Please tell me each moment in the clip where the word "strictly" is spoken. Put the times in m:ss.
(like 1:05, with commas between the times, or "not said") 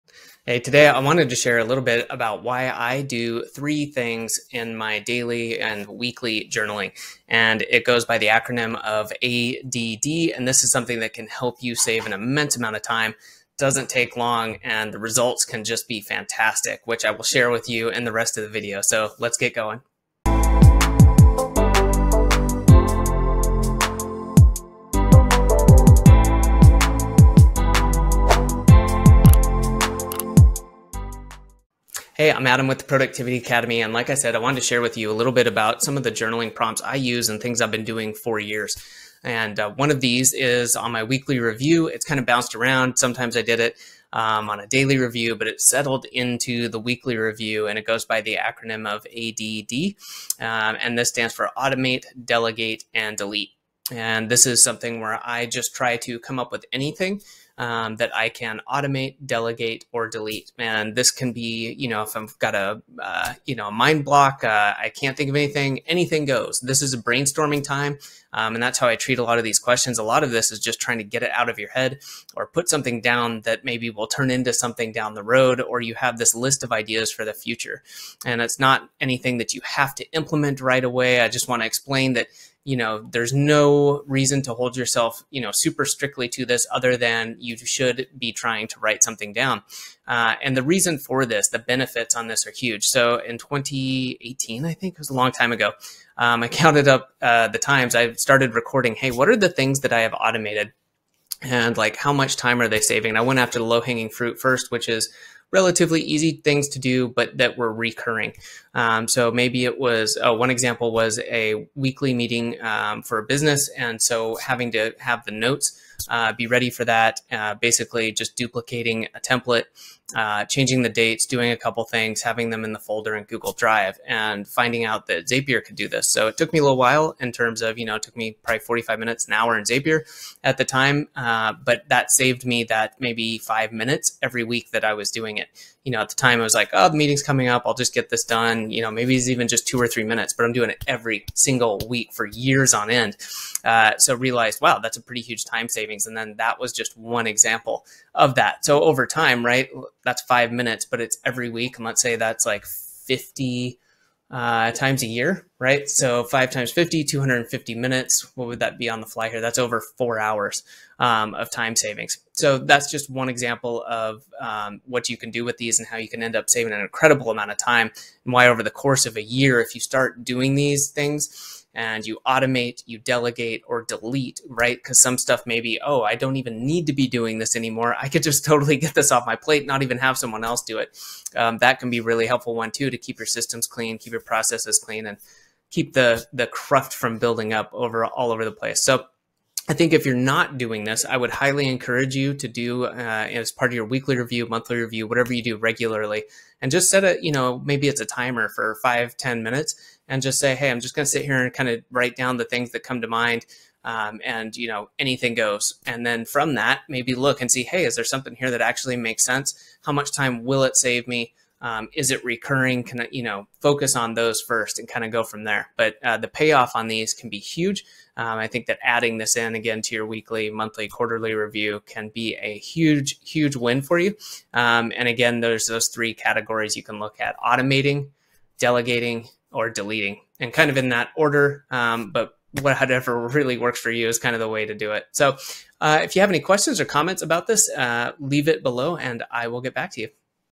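1:25.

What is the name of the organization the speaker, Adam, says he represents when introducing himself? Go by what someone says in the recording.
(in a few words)
Productivity Academy.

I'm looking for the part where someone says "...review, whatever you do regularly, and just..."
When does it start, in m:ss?
3:14.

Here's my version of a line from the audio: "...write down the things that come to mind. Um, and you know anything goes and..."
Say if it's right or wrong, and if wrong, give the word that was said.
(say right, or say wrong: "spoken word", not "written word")
right.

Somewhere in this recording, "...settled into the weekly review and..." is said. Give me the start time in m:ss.
0:45.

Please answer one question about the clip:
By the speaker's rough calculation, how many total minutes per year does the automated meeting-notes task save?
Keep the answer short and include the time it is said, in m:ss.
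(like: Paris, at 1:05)
250 minutes, at 2:37.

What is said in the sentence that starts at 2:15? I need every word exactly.
You know, at the time I was like, oh, the meeting's coming up.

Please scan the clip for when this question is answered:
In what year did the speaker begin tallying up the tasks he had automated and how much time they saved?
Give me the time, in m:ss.
1:33.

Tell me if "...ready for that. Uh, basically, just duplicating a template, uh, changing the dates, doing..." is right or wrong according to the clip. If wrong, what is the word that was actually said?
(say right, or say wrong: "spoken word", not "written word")
right.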